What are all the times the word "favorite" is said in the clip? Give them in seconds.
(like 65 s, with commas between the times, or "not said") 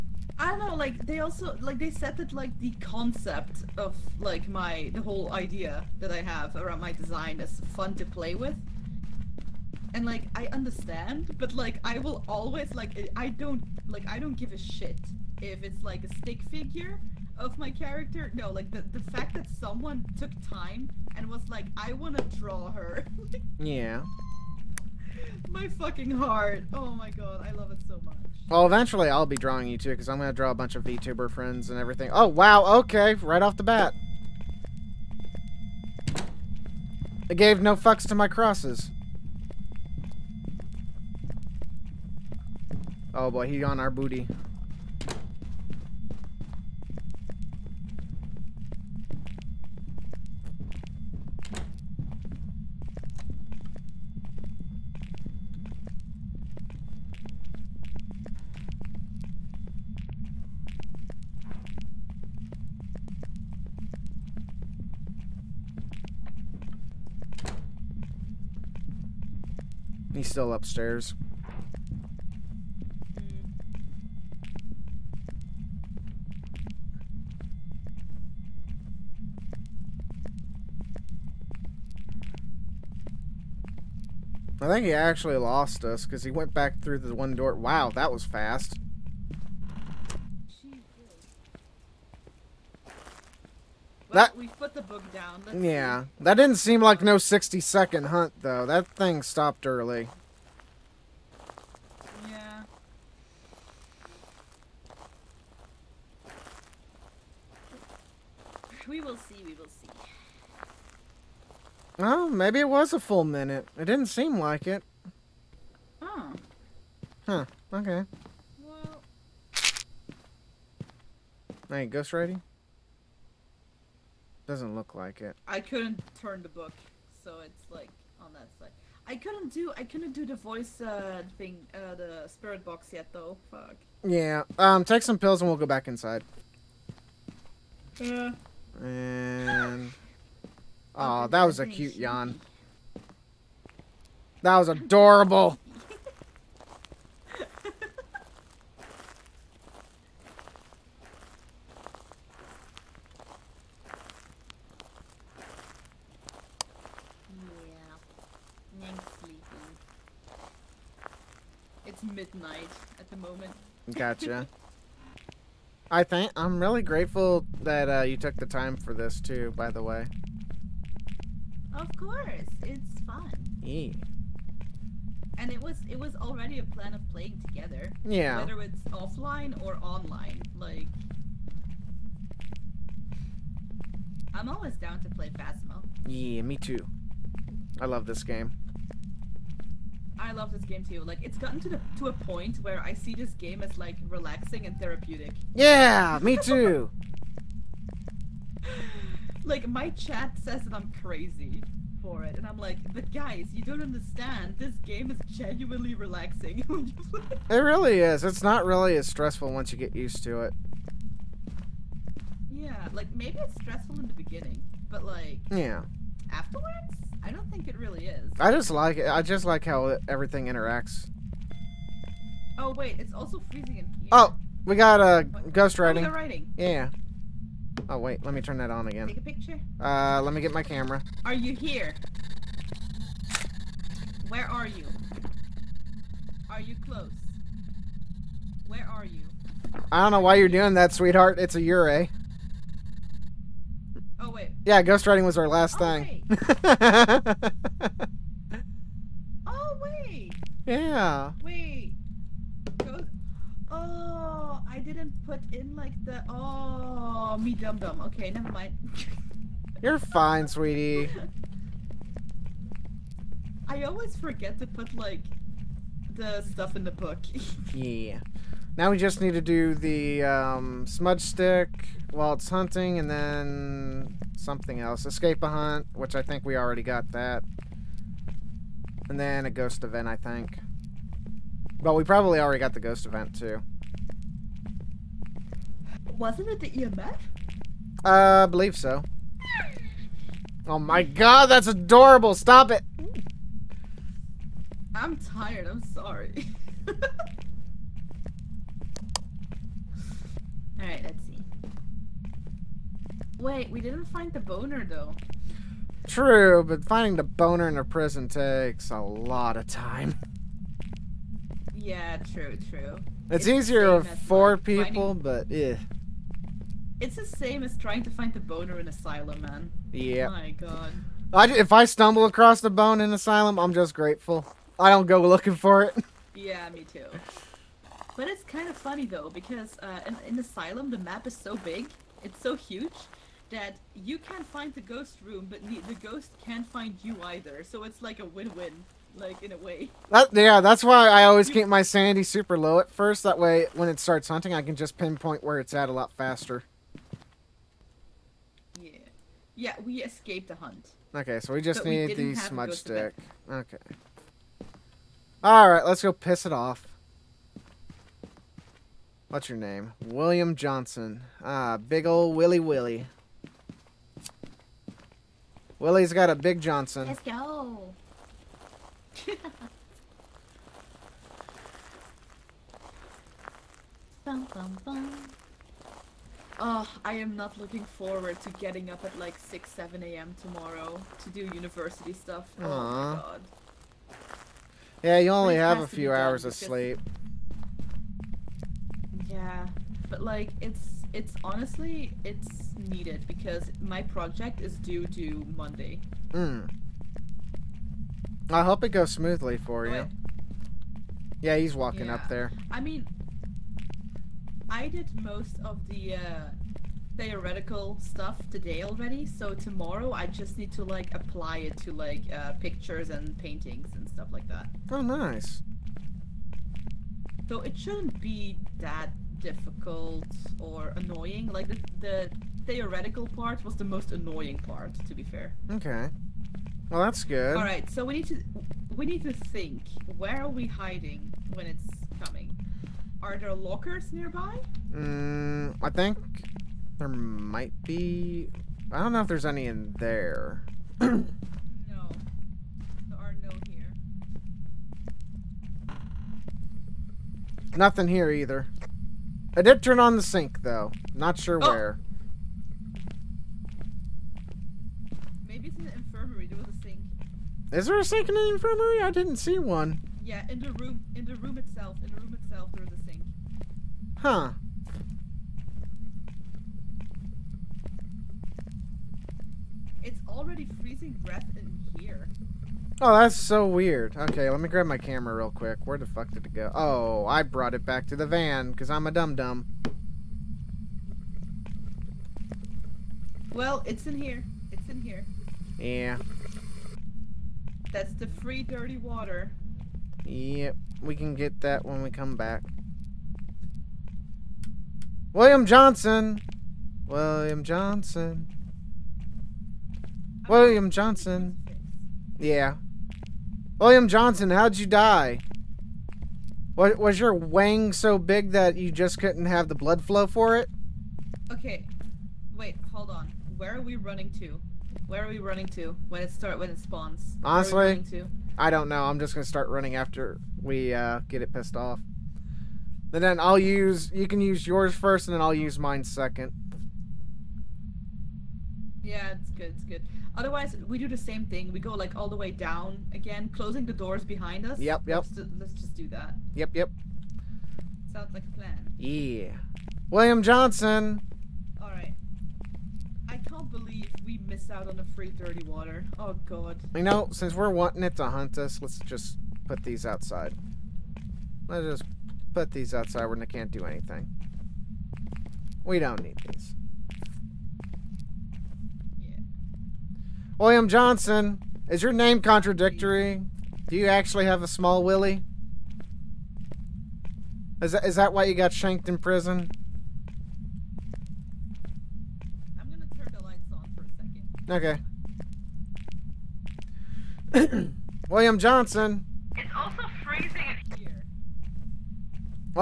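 not said.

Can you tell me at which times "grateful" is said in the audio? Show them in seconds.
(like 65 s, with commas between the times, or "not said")
166 s, 323 s.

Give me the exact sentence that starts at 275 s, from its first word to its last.
Escape a hunt, which I think we already got that.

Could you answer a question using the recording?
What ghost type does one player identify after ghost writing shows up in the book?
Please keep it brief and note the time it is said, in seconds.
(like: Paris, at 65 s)
Yurei, at 241 s.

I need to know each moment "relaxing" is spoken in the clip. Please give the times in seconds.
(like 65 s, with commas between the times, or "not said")
194 s, 205 s.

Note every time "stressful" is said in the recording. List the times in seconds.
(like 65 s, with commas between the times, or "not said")
209 s, 213 s.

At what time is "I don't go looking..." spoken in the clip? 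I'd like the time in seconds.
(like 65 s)
324 s.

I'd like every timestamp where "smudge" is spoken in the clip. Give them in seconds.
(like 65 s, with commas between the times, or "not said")
270 s, 352 s.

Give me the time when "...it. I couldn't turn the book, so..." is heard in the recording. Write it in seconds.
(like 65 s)
125 s.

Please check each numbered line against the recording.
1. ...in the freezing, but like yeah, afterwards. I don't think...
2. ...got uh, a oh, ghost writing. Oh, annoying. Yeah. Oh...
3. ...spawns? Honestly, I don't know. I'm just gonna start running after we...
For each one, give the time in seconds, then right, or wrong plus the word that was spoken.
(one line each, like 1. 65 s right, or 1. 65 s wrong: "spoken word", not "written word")
1. 213 s wrong: "beginning", not "freezing"
2. 224 s wrong: "writing", not "annoying"
3. 516 s right.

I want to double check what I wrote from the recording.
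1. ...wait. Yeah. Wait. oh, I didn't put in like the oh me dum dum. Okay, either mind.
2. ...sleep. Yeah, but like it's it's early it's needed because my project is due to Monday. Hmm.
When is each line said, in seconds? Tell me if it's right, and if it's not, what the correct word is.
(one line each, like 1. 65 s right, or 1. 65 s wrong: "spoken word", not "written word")
1. 249 s wrong: "never", not "either"
2. 386 s wrong: "honestly", not "early".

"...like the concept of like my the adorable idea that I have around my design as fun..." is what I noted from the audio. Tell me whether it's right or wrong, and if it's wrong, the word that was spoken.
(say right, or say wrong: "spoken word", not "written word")
wrong: "whole", not "adorable".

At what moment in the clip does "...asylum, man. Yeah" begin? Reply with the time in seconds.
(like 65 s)
318 s.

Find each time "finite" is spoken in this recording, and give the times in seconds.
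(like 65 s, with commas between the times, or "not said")
not said.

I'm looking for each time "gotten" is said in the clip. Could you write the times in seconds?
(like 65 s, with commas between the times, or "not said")
191 s.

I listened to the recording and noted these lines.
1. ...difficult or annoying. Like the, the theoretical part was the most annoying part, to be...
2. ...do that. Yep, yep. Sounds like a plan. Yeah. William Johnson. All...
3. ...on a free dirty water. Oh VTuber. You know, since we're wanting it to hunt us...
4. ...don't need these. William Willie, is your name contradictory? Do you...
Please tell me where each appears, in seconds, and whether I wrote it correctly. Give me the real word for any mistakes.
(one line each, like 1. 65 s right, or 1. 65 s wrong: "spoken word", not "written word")
1. 419 s right
2. 535 s right
3. 544 s wrong: "God", not "VTuber"
4. 555 s wrong: "Johnson", not "Willie".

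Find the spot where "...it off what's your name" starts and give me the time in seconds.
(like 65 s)
356 s.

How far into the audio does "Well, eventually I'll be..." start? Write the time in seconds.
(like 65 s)
28 s.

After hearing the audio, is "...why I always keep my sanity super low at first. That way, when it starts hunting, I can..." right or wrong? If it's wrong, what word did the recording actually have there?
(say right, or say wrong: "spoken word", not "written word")
right.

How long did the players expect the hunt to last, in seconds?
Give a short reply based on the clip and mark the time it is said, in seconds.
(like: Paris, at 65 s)
60, at 97 s.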